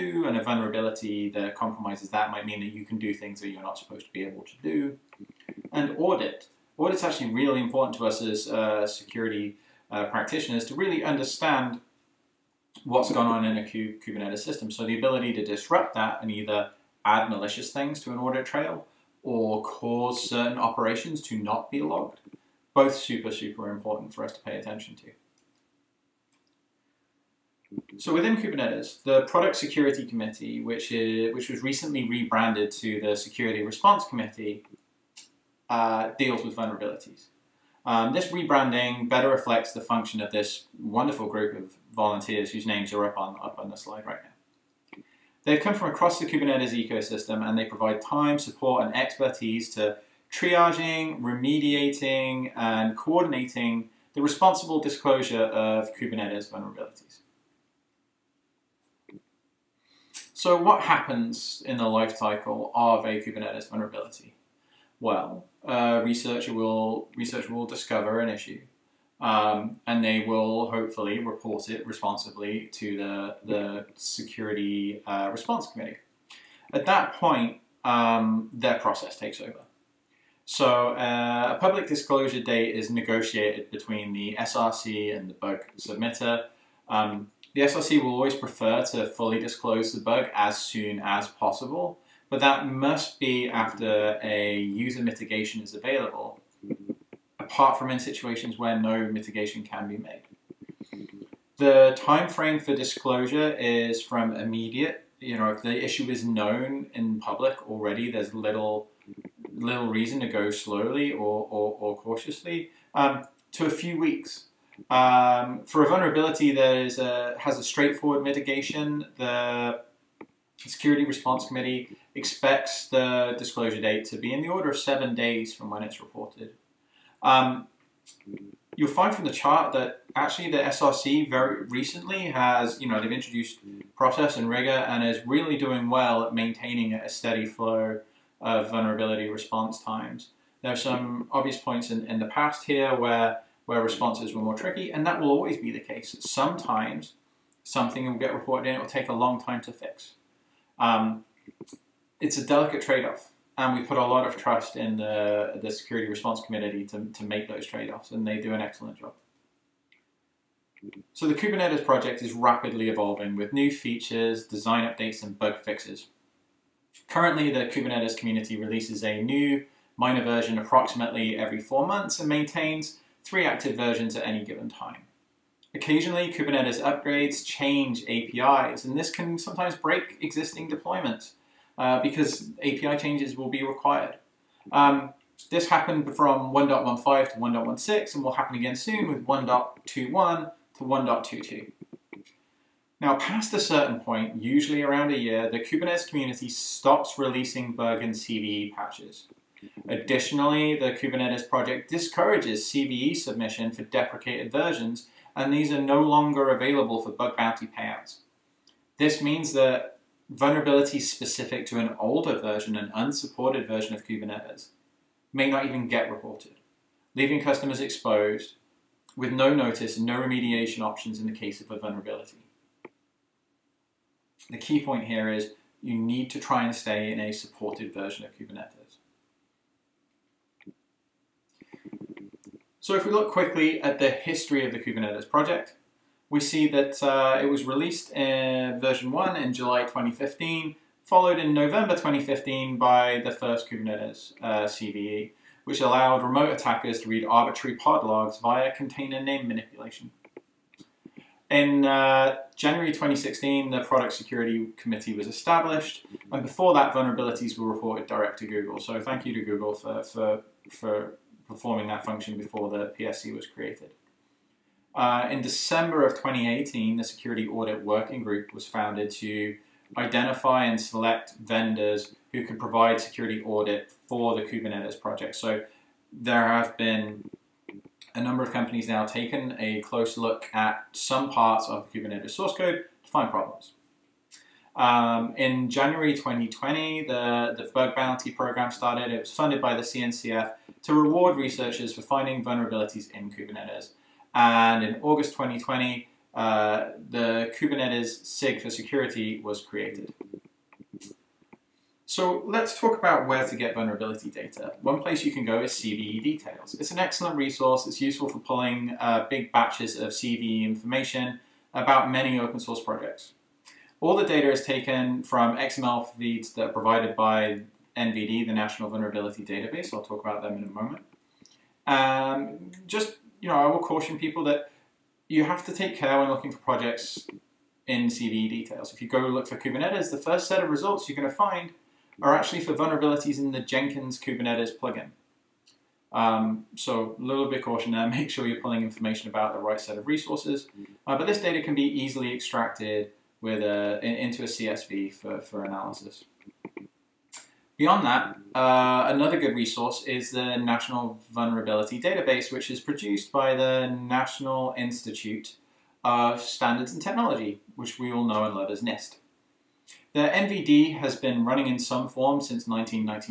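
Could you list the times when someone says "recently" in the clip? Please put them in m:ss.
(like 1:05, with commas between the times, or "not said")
0:31, 2:11.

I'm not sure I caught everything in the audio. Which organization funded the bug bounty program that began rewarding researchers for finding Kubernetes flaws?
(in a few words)
CNCF.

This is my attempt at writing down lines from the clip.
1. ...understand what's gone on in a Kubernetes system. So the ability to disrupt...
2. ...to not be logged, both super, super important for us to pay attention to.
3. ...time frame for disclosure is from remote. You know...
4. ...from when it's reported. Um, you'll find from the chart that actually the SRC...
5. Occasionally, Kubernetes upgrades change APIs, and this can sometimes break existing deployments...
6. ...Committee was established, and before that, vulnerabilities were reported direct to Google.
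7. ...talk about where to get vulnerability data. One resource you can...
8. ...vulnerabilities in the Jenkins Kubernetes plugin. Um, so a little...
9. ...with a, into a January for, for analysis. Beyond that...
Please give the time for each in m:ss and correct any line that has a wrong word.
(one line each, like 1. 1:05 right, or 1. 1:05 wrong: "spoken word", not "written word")
1. 0:11 right
2. 0:21 right
3. 1:41 wrong: "immediate", not "remote"
4. 2:05 right
5. 2:55 right
6. 4:14 right
7. 5:02 wrong: "place", not "resource"
8. 5:32 right
9. 5:43 wrong: "CSV", not "January".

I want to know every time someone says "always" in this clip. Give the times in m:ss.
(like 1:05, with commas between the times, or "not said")
1:28, 2:25.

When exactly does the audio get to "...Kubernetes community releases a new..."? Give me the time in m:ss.
2:47.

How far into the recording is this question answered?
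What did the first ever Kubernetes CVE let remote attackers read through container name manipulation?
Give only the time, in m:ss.
4:07.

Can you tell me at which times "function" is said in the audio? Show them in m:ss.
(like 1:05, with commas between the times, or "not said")
0:39, 4:22.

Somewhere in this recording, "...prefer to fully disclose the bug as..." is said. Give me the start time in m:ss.
1:28.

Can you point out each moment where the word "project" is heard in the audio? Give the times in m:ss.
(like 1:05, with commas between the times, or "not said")
2:41, 3:21, 3:55, 4:34, 5:12, 5:26.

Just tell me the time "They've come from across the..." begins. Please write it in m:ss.
0:45.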